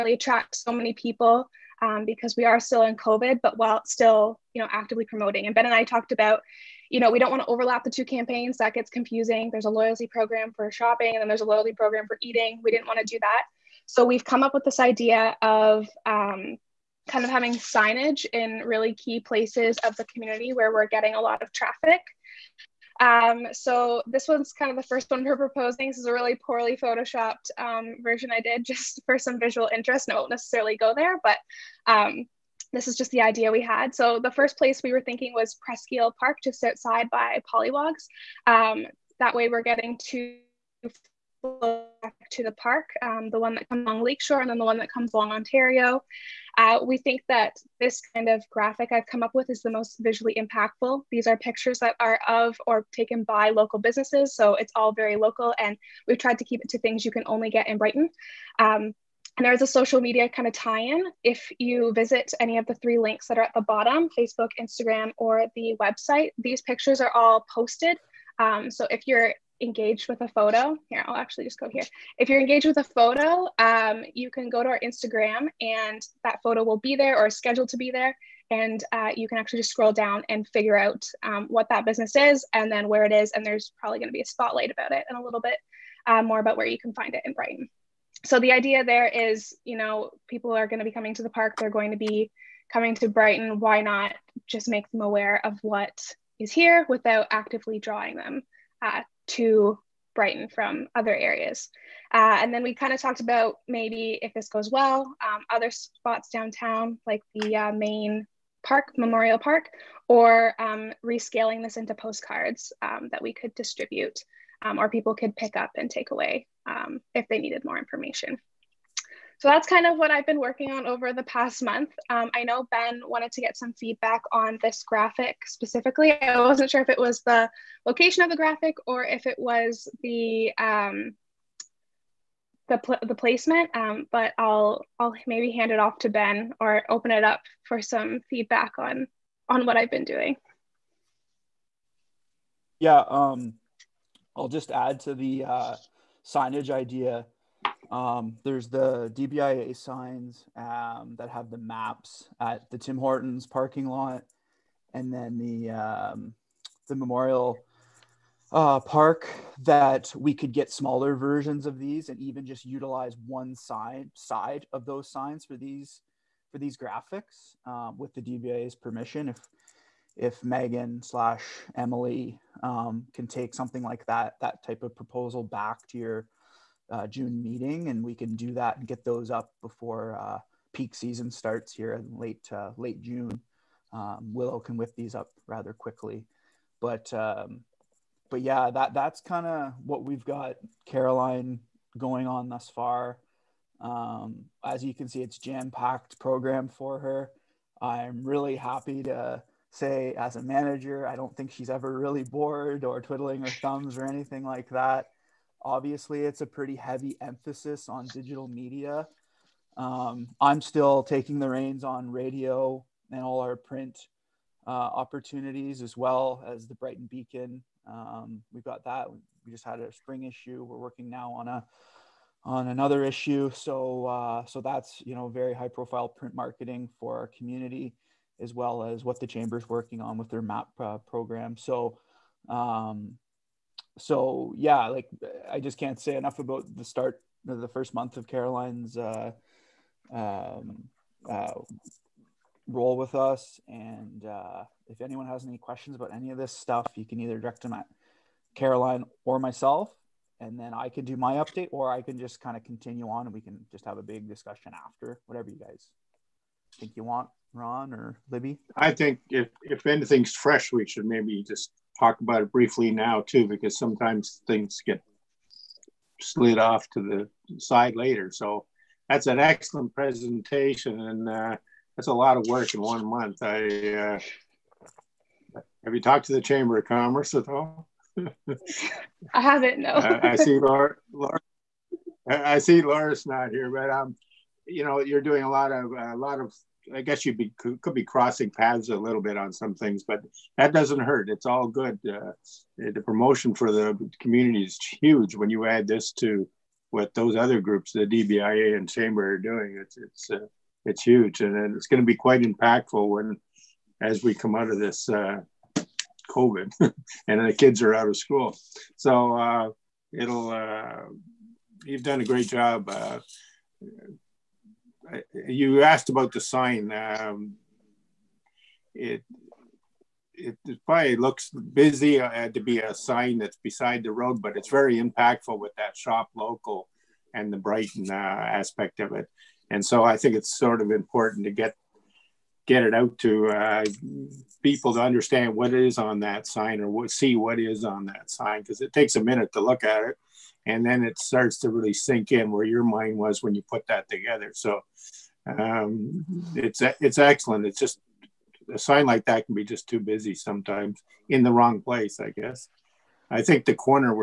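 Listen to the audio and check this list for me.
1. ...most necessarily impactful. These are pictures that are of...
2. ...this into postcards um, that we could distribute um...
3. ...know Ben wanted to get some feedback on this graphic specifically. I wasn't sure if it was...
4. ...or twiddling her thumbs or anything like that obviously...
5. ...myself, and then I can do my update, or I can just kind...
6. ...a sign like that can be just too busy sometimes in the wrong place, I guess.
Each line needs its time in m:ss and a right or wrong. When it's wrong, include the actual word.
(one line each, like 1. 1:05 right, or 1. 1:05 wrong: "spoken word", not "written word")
1. 0:49 wrong: "visually", not "necessarily"
2. 1:51 right
3. 2:02 right
4. 3:22 right
5. 4:09 right
6. 5:48 right.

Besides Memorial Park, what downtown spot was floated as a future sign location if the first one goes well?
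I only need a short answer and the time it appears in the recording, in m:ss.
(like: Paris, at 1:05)
main park, at 1:47.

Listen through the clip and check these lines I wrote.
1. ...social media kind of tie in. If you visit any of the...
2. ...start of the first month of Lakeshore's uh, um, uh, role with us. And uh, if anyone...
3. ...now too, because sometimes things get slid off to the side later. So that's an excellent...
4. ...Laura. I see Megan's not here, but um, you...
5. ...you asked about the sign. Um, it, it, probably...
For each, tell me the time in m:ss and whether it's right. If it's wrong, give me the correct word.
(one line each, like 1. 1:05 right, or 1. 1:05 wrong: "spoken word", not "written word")
1. 0:59 right
2. 3:56 wrong: "Caroline", not "Lakeshore"
3. 4:22 right
4. 4:41 wrong: "Laura", not "Megan"
5. 5:15 right.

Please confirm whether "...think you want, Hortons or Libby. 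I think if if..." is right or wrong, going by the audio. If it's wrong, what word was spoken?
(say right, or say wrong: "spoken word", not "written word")
wrong: "Ron", not "Hortons".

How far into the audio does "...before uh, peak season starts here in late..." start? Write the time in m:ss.
2:59.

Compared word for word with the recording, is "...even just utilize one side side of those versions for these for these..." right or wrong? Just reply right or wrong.
wrong.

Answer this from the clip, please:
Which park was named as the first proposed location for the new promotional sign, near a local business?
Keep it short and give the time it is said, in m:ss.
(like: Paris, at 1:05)
Isle Park, at 0:35.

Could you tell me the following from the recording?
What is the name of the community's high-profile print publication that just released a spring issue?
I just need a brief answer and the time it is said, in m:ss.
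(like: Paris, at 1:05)
Brighton Beacon, at 3:36.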